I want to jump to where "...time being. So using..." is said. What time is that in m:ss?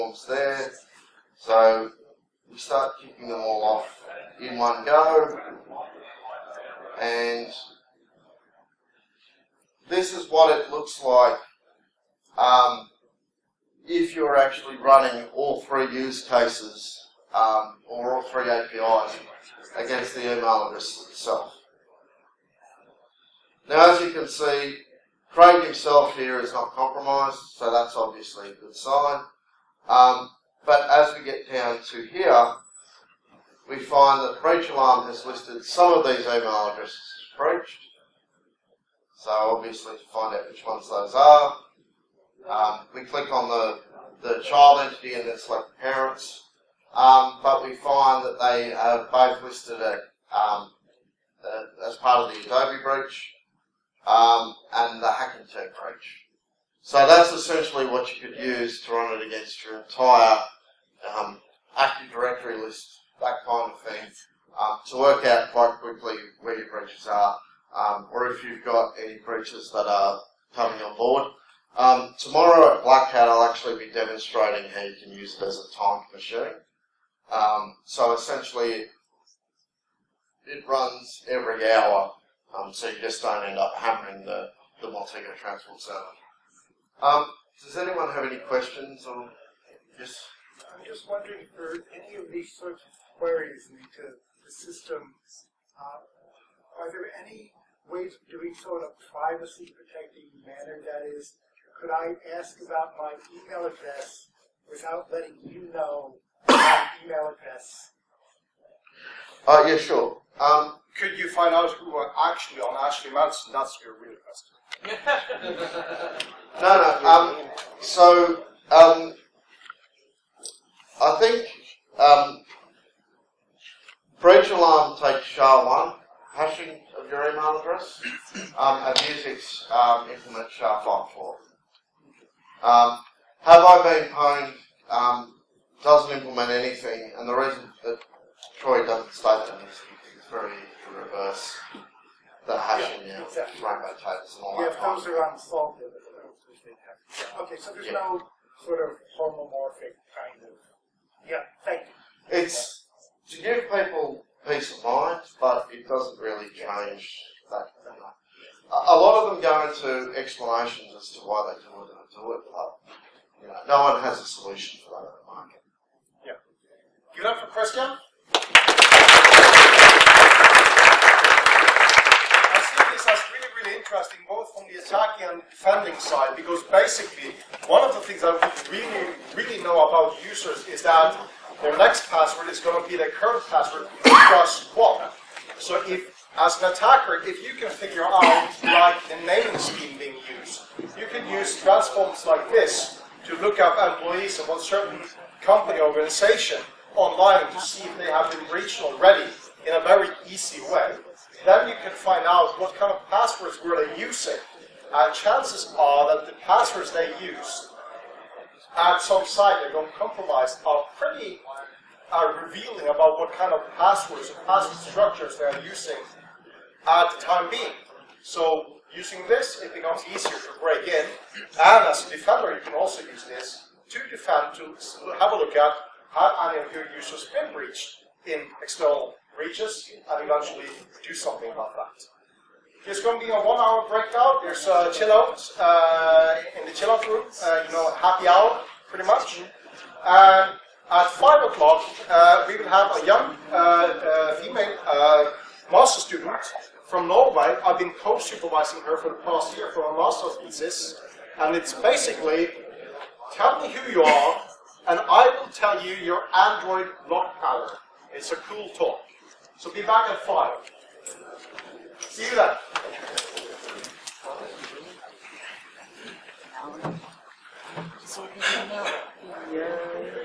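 3:37.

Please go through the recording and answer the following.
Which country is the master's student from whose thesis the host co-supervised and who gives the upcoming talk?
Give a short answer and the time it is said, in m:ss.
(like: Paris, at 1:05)
Norway, at 4:07.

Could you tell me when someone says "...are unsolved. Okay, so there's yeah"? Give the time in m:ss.
2:25.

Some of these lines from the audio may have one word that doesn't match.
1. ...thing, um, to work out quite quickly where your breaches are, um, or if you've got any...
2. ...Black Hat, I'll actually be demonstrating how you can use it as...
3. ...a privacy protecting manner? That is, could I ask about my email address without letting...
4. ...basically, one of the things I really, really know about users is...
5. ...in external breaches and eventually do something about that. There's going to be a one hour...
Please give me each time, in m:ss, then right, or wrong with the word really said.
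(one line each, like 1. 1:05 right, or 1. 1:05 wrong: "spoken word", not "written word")
1. 1:03 right
2. 1:12 right
3. 1:38 right
4. 2:56 right
5. 3:48 right.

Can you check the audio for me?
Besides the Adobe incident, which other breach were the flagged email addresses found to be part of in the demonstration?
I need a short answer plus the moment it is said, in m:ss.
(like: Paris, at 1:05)
Hacking Team, at 0:55.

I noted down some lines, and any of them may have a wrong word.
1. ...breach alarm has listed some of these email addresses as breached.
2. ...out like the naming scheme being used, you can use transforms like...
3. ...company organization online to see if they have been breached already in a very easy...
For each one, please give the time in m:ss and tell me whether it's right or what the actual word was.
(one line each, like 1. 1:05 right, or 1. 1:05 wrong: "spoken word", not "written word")
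1. 0:34 right
2. 3:08 right
3. 3:15 right.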